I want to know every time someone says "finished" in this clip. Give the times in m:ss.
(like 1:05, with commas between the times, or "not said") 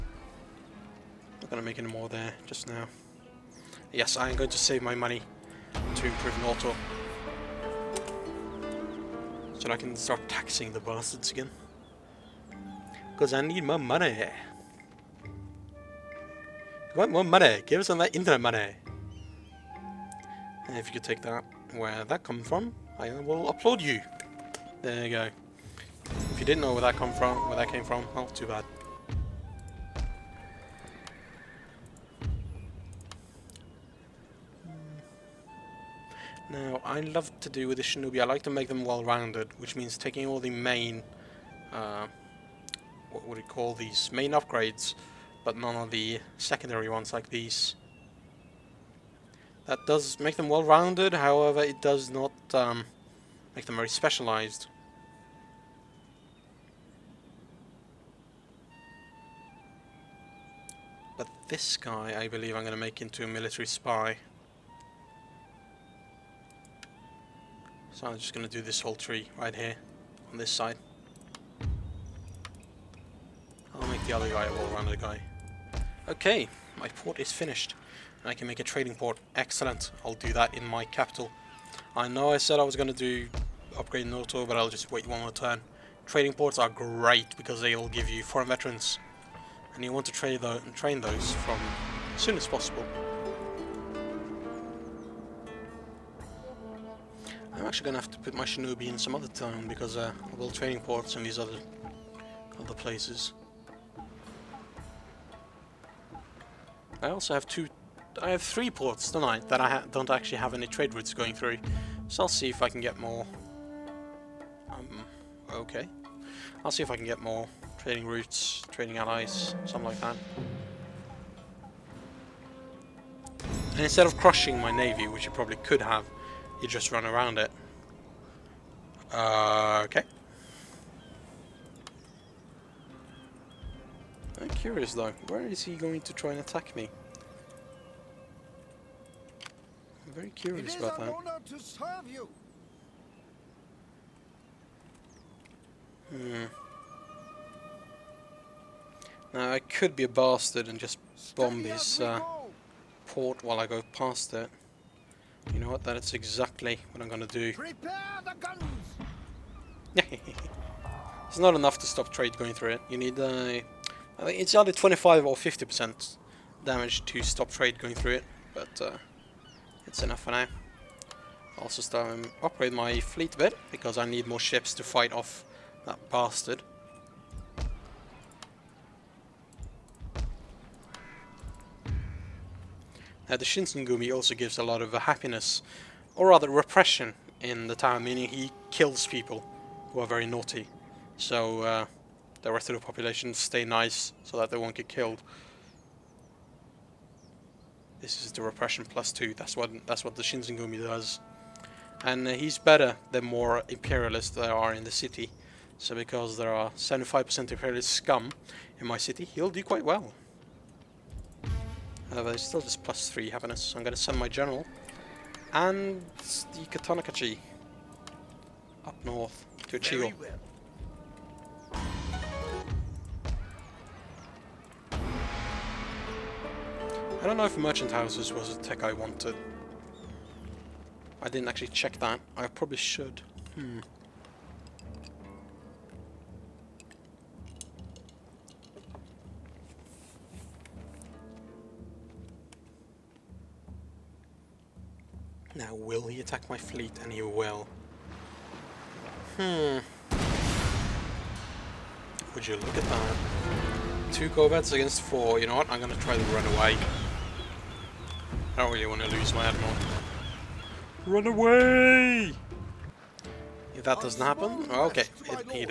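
1:17.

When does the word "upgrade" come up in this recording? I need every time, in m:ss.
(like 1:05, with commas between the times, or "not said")
0:44, 1:23, 2:52.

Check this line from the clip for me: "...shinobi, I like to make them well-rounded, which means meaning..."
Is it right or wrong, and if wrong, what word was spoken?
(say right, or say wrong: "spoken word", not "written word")
wrong: "taking", not "meaning".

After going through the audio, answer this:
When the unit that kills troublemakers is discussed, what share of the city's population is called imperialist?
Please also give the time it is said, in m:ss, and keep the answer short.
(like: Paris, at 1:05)
75%, at 3:26.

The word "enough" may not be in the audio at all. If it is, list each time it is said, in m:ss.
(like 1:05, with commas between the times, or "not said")
2:41, 2:50.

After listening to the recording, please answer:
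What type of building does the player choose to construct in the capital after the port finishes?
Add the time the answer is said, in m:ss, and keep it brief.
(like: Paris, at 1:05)
Trading port, at 1:18.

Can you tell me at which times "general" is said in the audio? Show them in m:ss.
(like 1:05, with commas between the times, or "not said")
3:34.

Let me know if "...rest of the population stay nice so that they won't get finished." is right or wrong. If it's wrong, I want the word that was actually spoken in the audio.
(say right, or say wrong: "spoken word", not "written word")
wrong: "killed", not "finished".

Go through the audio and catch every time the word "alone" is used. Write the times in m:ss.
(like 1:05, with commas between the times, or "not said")
not said.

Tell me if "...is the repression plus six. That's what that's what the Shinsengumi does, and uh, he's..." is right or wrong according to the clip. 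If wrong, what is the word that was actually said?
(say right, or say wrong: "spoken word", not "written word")
wrong: "two", not "six".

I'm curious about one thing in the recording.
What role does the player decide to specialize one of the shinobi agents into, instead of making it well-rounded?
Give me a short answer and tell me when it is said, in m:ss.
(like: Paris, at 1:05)
Military spy, at 1:03.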